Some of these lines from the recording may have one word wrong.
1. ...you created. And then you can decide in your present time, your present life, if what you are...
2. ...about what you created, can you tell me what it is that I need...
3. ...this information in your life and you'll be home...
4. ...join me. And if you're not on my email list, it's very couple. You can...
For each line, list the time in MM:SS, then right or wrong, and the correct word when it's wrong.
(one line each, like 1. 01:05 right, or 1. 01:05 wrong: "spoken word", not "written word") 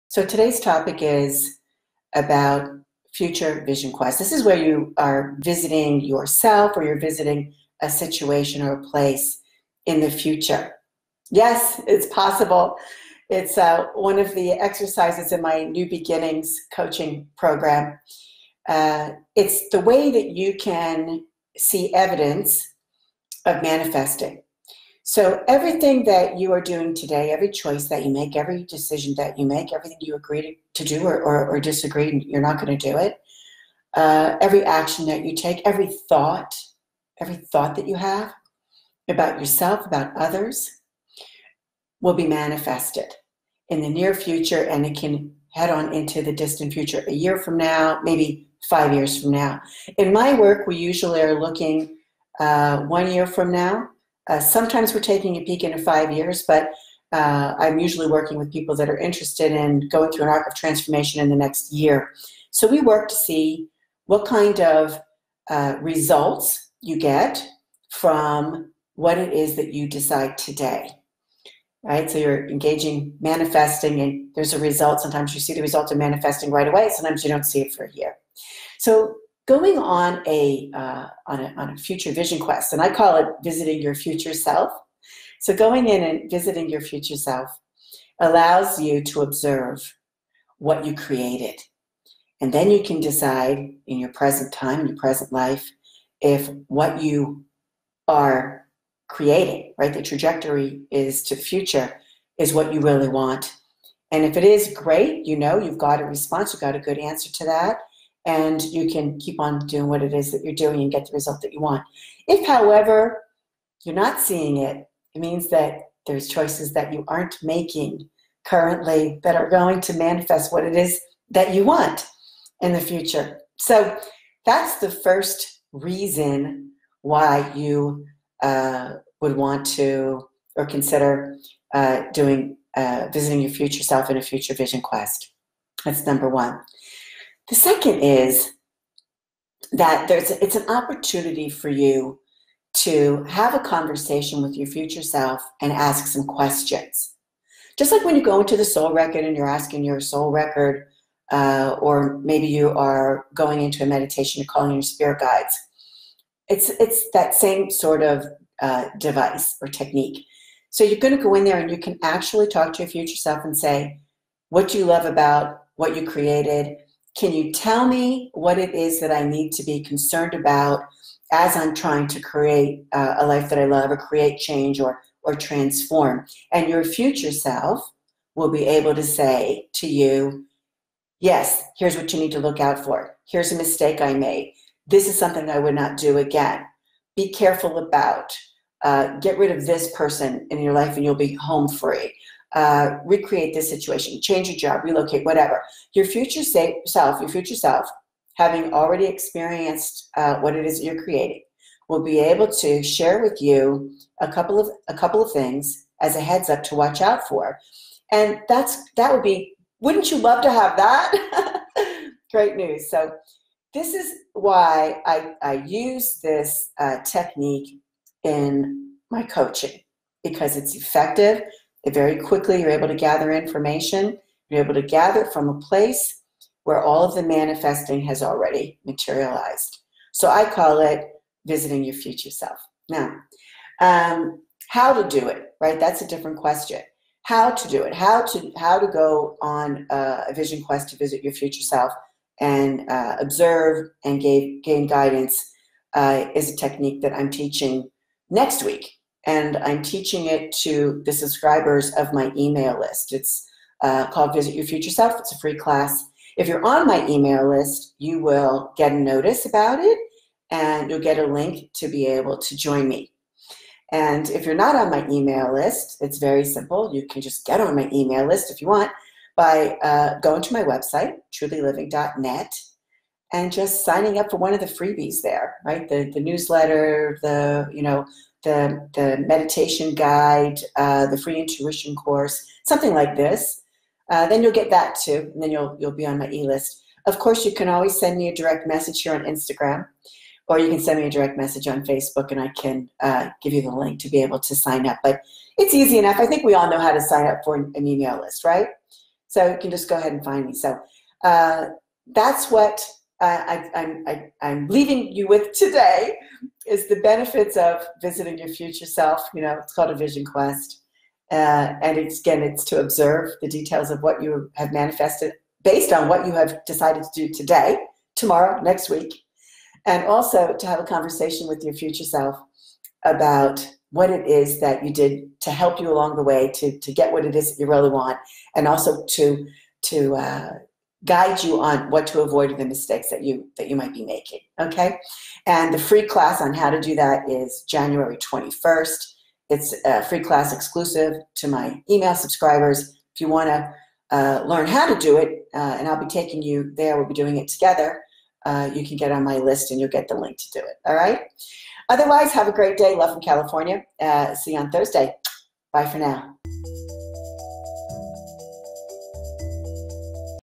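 1. 01:30 right
2. 02:45 right
3. 03:09 wrong: "person", not "information"
4. 04:22 wrong: "simple", not "couple".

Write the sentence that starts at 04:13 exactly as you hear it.
It's uh, called Visit Your Future Self.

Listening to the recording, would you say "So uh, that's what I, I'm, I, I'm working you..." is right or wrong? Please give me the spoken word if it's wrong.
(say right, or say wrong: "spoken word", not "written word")
wrong: "leaving", not "working".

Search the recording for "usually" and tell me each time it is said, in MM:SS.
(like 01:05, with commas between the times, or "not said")
00:50, 00:57.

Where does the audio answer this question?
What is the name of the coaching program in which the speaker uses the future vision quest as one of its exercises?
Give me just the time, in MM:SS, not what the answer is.
00:15.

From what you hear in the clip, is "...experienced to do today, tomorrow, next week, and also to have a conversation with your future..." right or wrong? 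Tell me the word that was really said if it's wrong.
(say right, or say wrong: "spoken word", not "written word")
wrong: "decided", not "experienced".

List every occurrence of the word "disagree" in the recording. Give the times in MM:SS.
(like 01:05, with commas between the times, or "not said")
00:31.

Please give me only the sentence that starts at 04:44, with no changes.
Uh, then you'll get that too, and then you'll you'll be on my e-list.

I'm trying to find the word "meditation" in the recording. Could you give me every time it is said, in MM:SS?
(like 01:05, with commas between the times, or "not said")
02:33, 04:39.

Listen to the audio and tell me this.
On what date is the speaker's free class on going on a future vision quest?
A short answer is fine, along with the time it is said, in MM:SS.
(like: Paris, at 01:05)
January 21st, at 05:37.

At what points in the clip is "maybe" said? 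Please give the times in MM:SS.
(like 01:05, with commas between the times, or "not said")
00:48, 02:32.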